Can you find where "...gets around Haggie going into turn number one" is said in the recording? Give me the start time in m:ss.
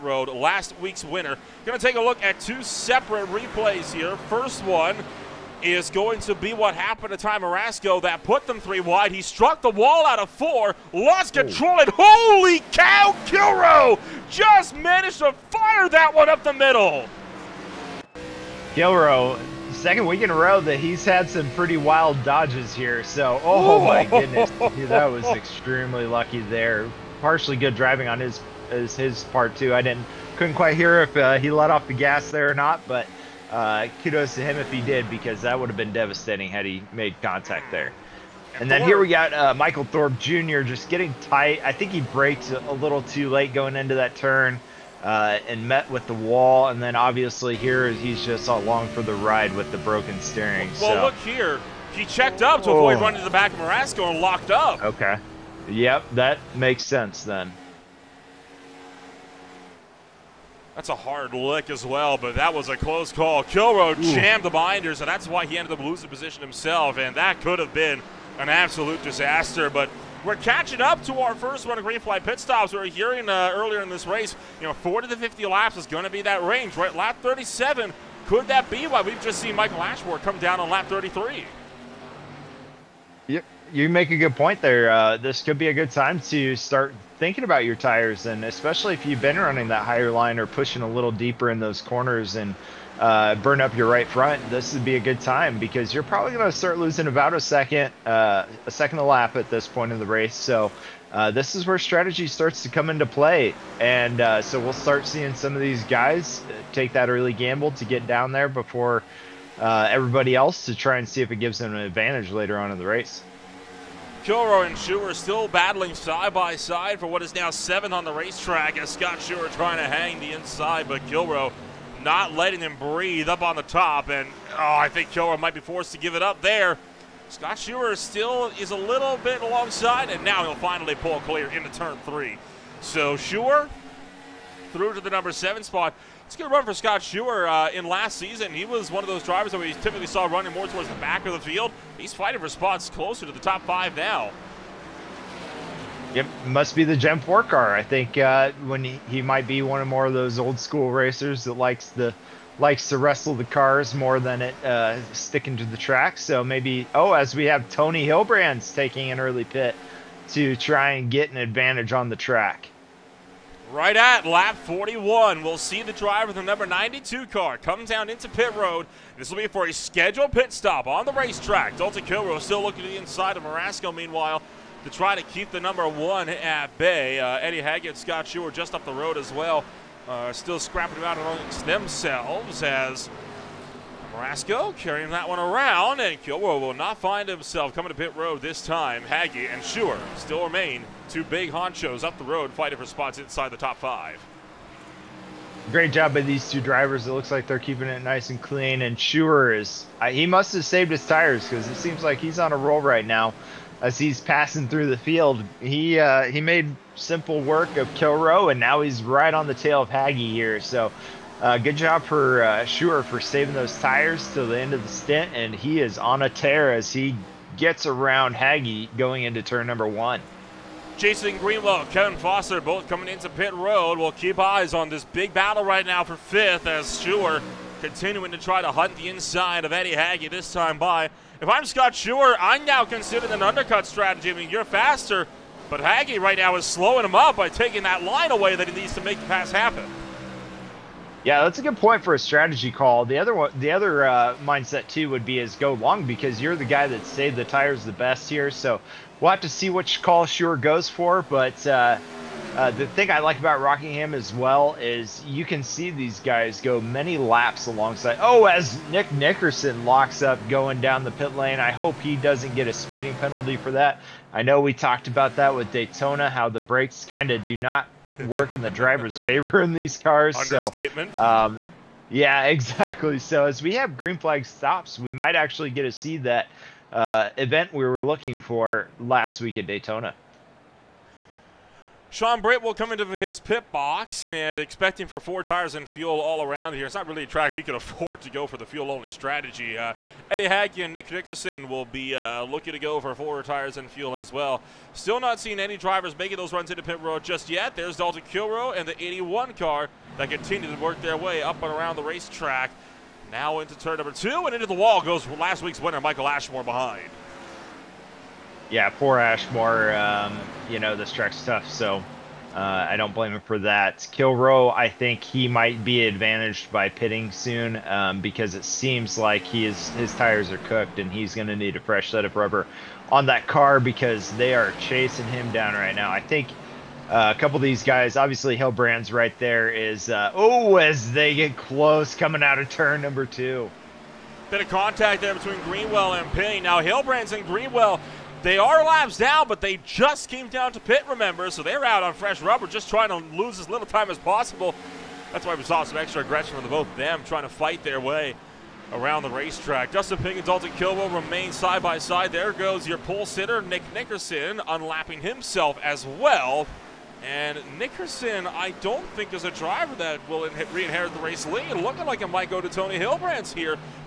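3:37.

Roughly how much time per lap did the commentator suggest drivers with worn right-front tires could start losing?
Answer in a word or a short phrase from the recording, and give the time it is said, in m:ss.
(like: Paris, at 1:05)
About a second, at 1:38.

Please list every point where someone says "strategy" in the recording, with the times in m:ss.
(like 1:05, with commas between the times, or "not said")
1:41, 3:53, 4:02, 4:49.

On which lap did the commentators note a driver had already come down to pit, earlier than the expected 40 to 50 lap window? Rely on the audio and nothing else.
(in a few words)
33.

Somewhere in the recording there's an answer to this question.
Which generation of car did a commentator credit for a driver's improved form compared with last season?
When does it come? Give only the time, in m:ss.
2:26.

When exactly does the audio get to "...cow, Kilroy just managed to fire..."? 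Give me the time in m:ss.
0:12.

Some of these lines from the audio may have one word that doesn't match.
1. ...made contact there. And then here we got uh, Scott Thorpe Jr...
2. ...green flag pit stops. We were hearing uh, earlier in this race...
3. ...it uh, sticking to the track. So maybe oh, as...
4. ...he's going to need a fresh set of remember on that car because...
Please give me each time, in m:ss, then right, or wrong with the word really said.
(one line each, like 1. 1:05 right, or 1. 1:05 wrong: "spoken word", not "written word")
1. 0:36 wrong: "Michael", not "Scott"
2. 1:11 right
3. 2:34 right
4. 5:21 wrong: "rubber", not "remember".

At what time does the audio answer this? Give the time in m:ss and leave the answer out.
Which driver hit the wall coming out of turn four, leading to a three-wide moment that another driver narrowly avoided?
0:07.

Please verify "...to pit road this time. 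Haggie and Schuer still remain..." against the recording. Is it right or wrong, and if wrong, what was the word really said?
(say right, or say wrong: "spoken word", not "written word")
right.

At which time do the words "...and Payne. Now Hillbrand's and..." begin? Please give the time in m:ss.
5:36.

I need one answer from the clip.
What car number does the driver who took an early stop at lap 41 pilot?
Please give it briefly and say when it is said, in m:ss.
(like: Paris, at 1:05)
92, at 2:46.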